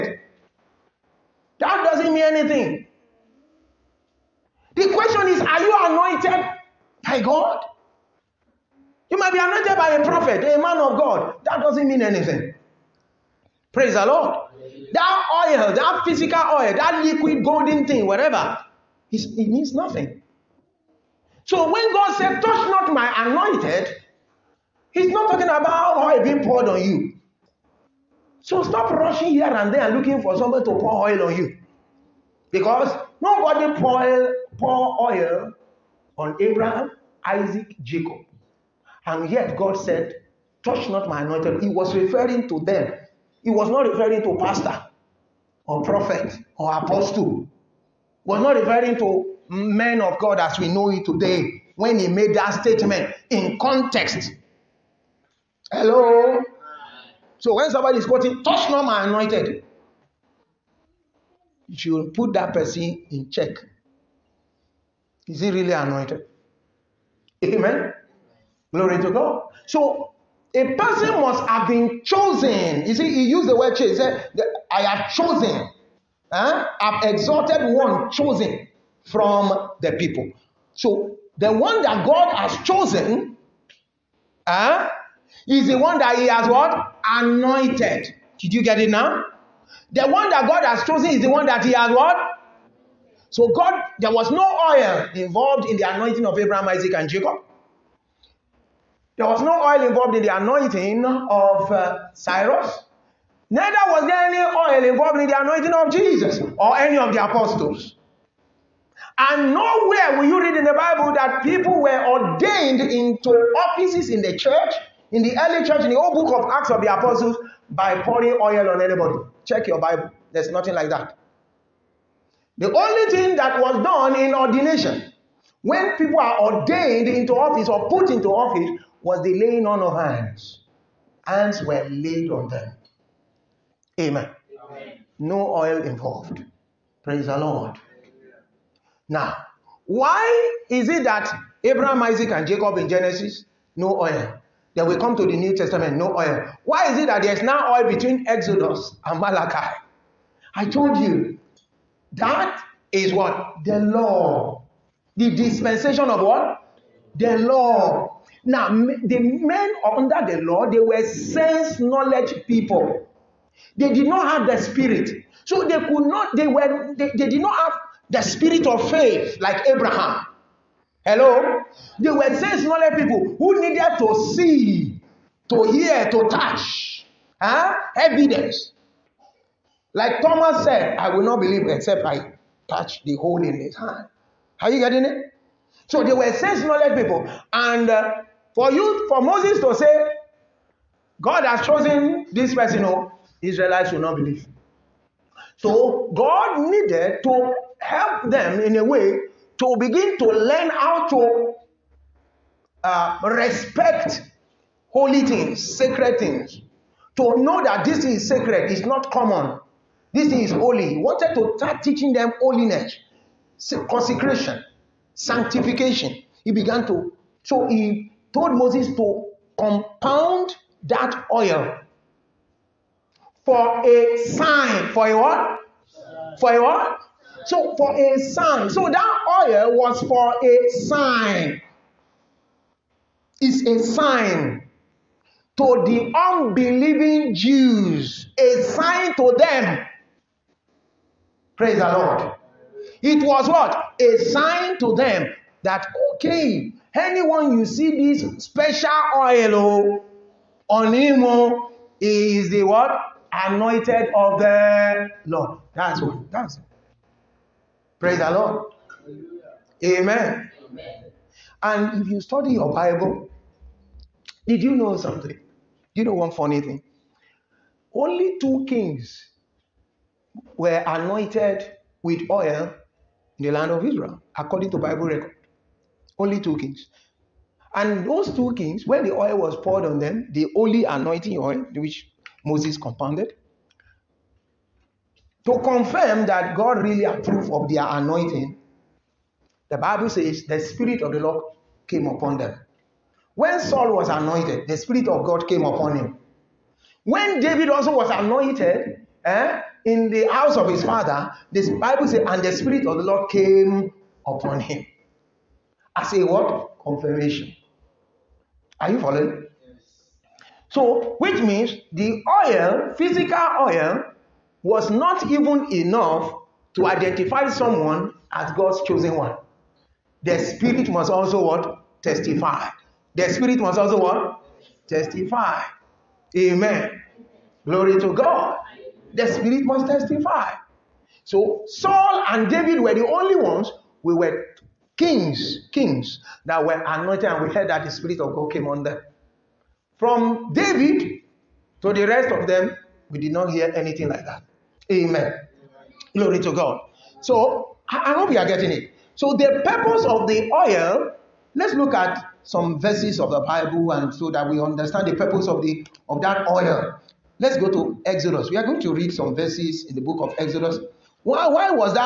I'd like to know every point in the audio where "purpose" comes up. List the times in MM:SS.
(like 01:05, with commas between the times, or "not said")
05:49, 05:55.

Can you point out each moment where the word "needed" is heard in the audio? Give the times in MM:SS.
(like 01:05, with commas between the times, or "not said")
02:53, 03:16.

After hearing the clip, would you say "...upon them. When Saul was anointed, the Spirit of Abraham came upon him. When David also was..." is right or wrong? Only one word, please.
wrong.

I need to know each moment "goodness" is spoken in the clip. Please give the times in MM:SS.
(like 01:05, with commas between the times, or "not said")
not said.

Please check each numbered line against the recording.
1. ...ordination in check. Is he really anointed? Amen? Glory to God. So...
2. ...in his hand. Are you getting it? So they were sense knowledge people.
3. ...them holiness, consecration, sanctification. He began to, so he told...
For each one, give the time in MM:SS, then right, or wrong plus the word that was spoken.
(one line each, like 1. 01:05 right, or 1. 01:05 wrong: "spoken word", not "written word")
1. 01:02 wrong: "person", not "ordination"
2. 03:03 right
3. 03:32 right.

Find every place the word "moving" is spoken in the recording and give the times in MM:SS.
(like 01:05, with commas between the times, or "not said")
not said.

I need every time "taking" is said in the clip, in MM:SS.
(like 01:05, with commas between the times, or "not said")
not said.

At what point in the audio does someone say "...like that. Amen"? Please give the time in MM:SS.
05:44.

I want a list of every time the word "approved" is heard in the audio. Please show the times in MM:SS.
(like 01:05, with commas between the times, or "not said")
04:47.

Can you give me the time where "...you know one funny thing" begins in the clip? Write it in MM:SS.
04:25.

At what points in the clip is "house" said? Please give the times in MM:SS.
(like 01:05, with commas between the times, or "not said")
05:00.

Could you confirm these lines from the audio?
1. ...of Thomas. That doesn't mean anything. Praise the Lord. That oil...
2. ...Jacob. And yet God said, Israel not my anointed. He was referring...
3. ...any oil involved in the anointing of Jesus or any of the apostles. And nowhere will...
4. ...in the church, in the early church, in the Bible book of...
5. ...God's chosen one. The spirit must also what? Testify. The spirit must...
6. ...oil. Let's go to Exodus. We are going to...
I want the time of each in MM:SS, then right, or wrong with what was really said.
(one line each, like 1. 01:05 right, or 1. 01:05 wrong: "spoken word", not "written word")
1. 00:10 wrong: "God", not "Thomas"
2. 00:37 wrong: "Touch", not "Israel"
3. 01:44 right
4. 01:54 wrong: "Old", not "Bible"
5. 05:18 right
6. 05:56 right.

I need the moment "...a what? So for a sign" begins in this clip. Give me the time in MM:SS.
03:46.